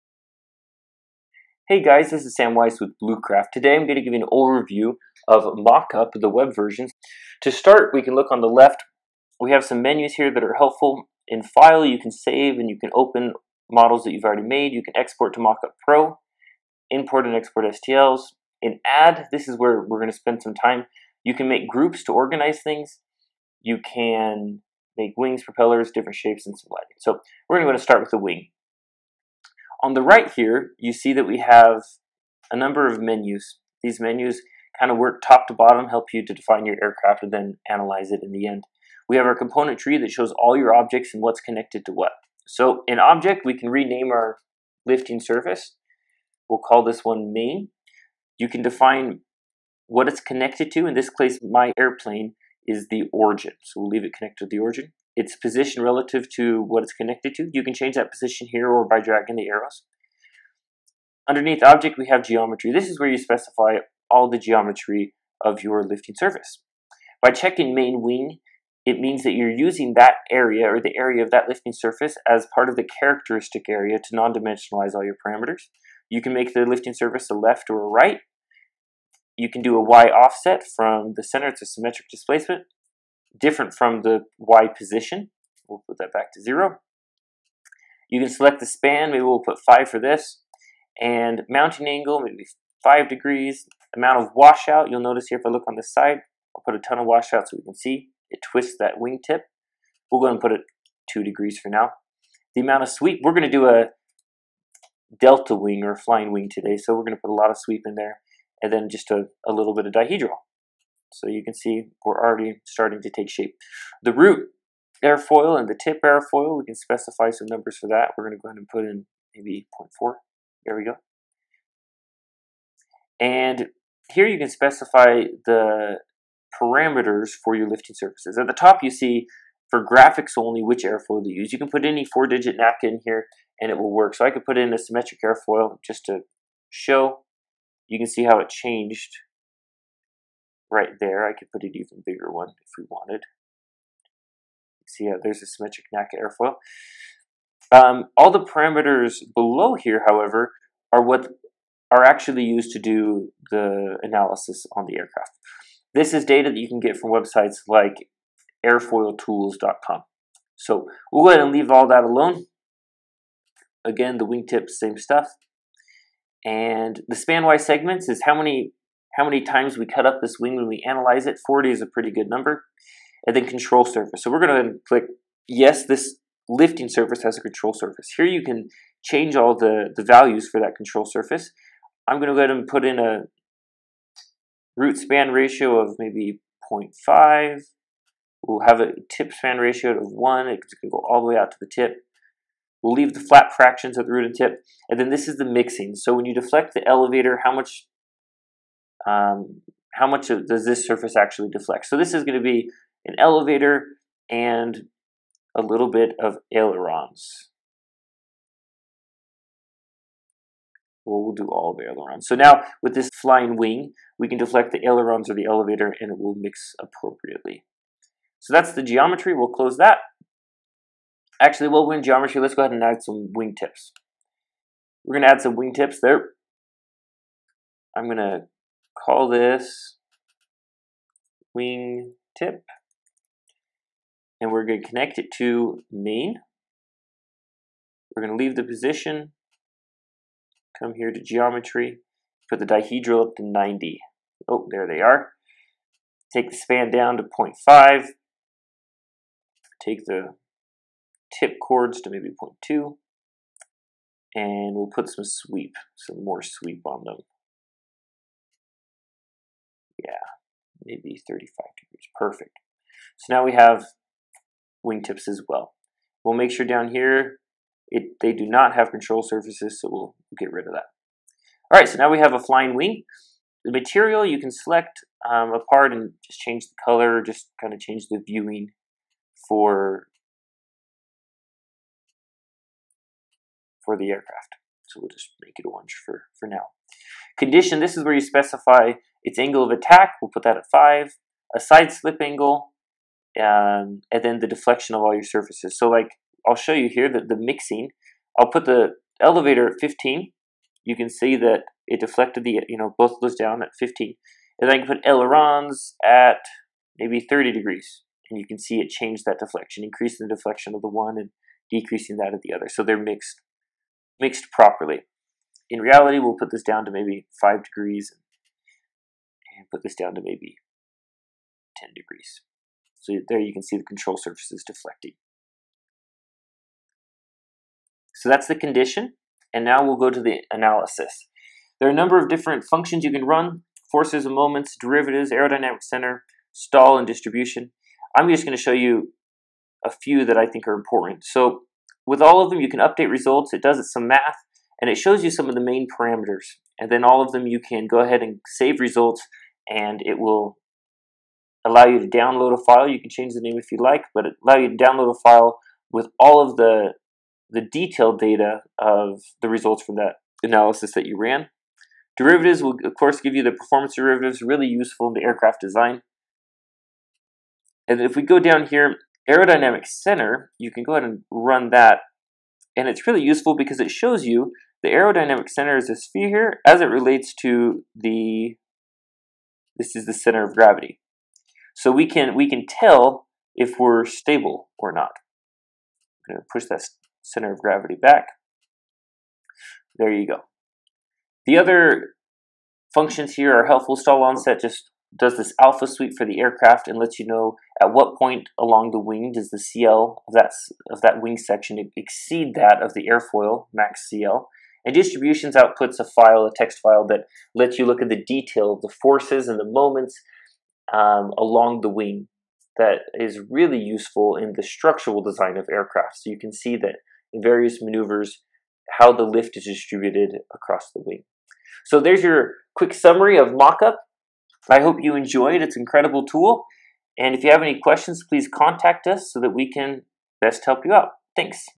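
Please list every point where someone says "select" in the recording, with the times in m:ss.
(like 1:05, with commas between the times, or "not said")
1:28, 4:34.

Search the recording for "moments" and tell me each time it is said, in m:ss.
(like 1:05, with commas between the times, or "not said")
5:34, 6:49.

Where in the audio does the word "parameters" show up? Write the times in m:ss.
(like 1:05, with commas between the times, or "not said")
1:15, 2:06, 2:28, 5:45.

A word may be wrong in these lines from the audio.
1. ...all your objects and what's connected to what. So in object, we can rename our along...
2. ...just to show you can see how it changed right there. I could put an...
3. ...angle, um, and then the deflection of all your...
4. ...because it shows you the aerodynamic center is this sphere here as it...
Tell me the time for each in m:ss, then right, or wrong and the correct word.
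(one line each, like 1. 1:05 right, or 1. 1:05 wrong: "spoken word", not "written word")
1. 0:40 wrong: "lifting", not "along"
2. 2:15 right
3. 4:52 right
4. 6:13 right.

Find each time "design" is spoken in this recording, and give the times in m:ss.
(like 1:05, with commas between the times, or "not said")
6:05, 6:55.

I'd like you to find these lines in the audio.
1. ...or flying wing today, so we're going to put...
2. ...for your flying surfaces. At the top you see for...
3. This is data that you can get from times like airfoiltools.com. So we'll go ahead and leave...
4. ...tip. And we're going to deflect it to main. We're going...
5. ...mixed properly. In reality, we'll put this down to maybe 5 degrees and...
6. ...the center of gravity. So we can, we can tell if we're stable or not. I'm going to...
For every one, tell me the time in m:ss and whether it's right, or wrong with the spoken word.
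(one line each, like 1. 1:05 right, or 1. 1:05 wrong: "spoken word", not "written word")
1. 1:45 right
2. 2:07 wrong: "lifting", not "flying"
3. 2:35 wrong: "websites", not "times"
4. 3:52 wrong: "connect", not "deflect"
5. 5:14 right
6. 6:20 right.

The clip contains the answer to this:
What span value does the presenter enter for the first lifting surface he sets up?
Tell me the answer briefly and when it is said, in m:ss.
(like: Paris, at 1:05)
5, at 1:29.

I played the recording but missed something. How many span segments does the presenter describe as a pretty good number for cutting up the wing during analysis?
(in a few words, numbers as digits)
40.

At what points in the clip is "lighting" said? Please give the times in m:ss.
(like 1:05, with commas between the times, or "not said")
0:26.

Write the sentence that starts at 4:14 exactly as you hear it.
And we'll put some sweep, some more sweep on them.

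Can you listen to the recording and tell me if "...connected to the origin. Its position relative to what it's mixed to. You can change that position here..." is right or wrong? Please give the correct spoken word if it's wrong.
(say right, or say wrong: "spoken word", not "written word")
wrong: "connected", not "mixed".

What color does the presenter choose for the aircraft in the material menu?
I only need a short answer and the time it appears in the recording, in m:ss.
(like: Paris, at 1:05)
orange, at 4:45.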